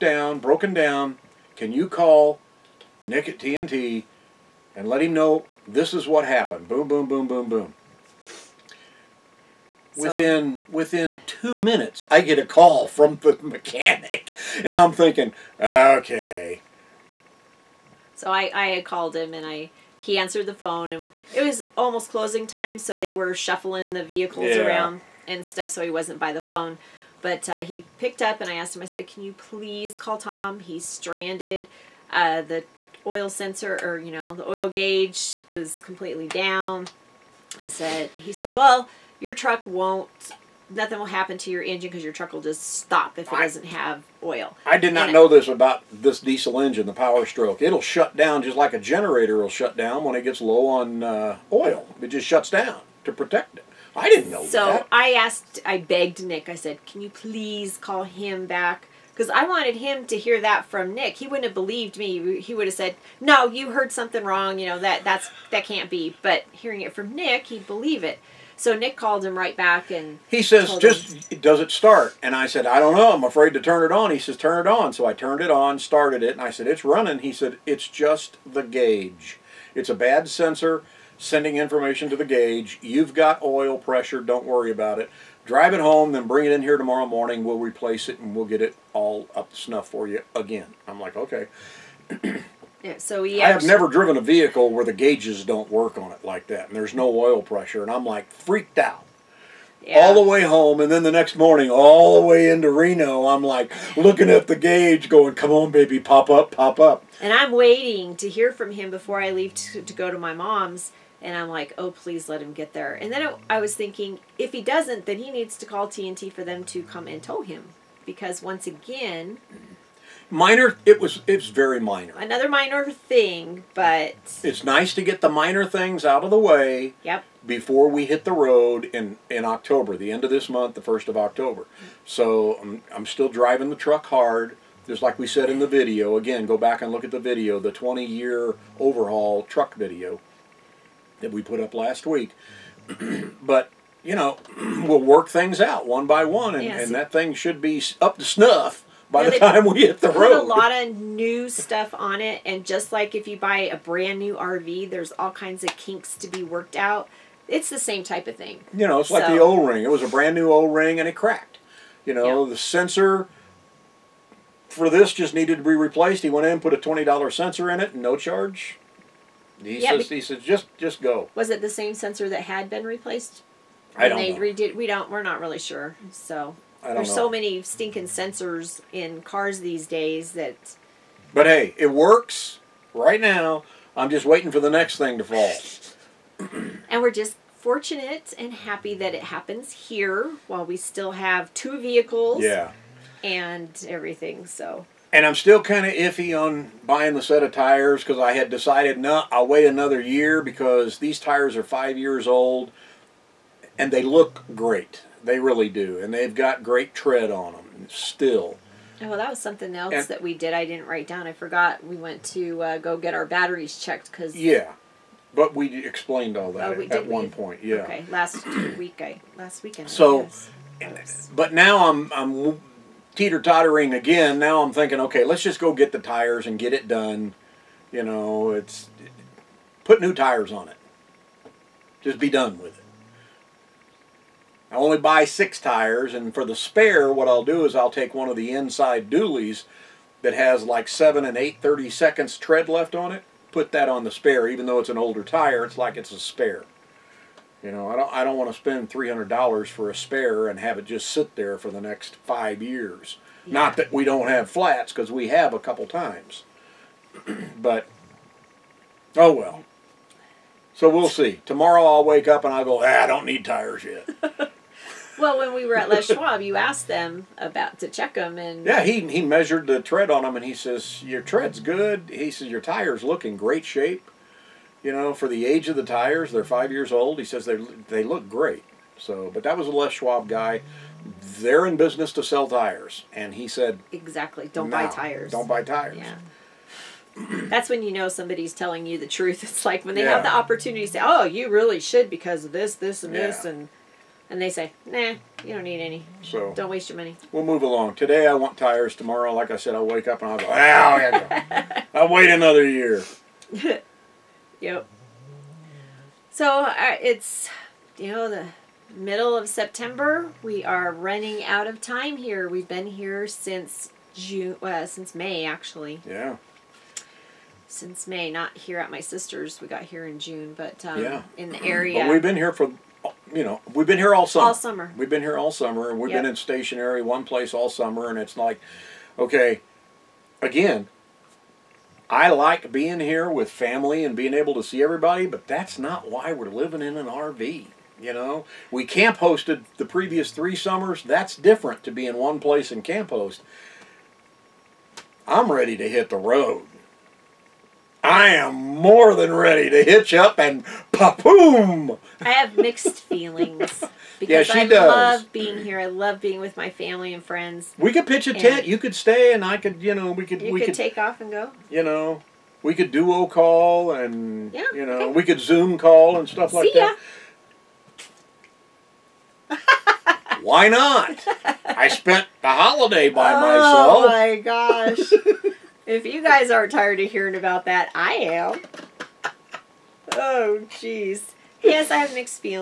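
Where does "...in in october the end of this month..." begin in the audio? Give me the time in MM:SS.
02:08.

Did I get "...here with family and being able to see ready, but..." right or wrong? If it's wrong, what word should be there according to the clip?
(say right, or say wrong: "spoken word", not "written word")
wrong: "everybody", not "ready".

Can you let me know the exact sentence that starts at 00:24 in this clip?
around and stuff, so he wasn't by the phone.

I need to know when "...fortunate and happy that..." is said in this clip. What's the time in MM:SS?
03:07.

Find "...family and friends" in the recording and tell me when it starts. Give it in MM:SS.
05:56.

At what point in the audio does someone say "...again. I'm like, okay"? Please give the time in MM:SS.
01:30.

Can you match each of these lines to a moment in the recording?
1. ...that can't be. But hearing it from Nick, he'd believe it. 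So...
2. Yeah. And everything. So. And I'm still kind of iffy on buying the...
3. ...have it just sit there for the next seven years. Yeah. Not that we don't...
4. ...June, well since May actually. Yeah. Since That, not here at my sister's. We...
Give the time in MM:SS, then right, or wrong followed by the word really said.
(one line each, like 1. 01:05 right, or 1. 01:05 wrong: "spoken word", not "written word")
1. 01:05 right
2. 03:12 right
3. 04:10 wrong: "five", not "seven"
4. 05:14 wrong: "May", not "That".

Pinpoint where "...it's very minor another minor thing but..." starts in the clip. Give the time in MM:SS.
02:01.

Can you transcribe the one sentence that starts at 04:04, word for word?
Even though it's an older tire, it's like it's a spare.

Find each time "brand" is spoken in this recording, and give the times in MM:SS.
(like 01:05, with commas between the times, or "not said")
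02:33, 02:40.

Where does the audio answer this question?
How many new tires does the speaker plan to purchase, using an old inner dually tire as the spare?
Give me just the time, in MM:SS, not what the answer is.
03:55.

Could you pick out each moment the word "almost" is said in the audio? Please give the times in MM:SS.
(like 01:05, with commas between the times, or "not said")
00:21.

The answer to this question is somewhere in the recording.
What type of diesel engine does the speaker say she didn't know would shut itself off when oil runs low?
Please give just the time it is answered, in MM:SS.
00:46.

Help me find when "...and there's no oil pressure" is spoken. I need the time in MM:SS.
01:36.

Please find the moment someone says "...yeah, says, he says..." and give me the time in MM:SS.
02:49.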